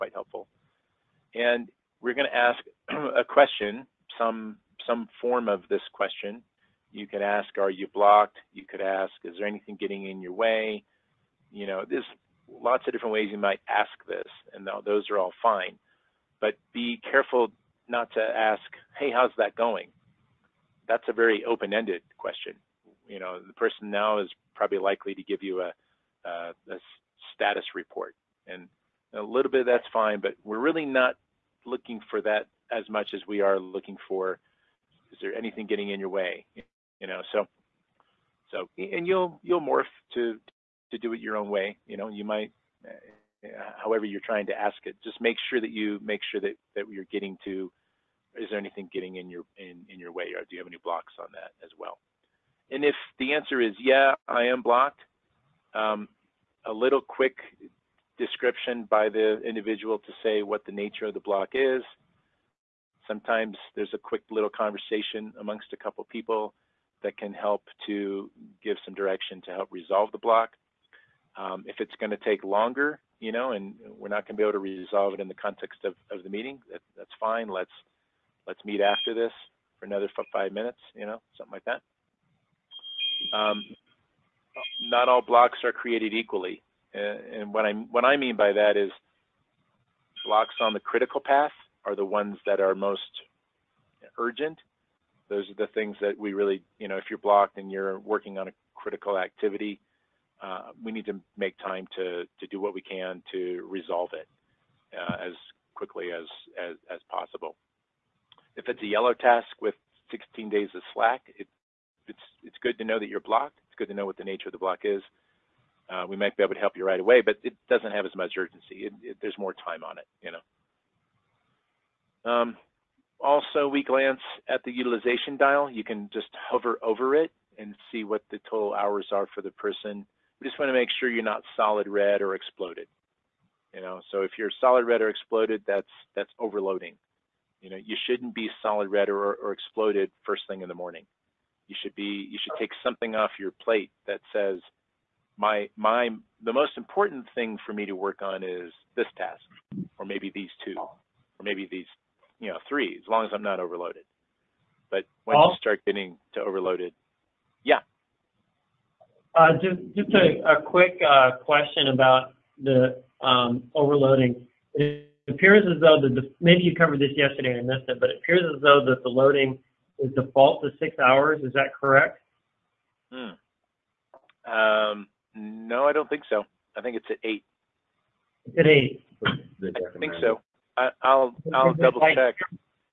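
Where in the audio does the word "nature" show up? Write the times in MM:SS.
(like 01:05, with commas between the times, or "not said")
01:00, 01:54.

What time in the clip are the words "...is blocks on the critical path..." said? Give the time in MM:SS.
01:28.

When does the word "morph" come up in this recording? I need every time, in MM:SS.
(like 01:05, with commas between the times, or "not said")
00:39.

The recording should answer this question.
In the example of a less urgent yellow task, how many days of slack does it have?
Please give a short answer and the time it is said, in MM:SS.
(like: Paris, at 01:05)
16, at 01:50.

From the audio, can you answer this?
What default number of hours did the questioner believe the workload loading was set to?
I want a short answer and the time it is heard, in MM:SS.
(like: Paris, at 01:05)
6, at 02:50.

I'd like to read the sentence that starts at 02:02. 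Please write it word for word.
Um, also, we glance at the utilization dial.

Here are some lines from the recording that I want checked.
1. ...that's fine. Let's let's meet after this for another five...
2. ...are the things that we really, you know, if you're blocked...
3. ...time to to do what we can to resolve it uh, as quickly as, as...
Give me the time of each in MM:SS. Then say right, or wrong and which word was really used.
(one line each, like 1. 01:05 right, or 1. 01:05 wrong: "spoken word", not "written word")
1. 01:16 right
2. 01:35 right
3. 01:41 right.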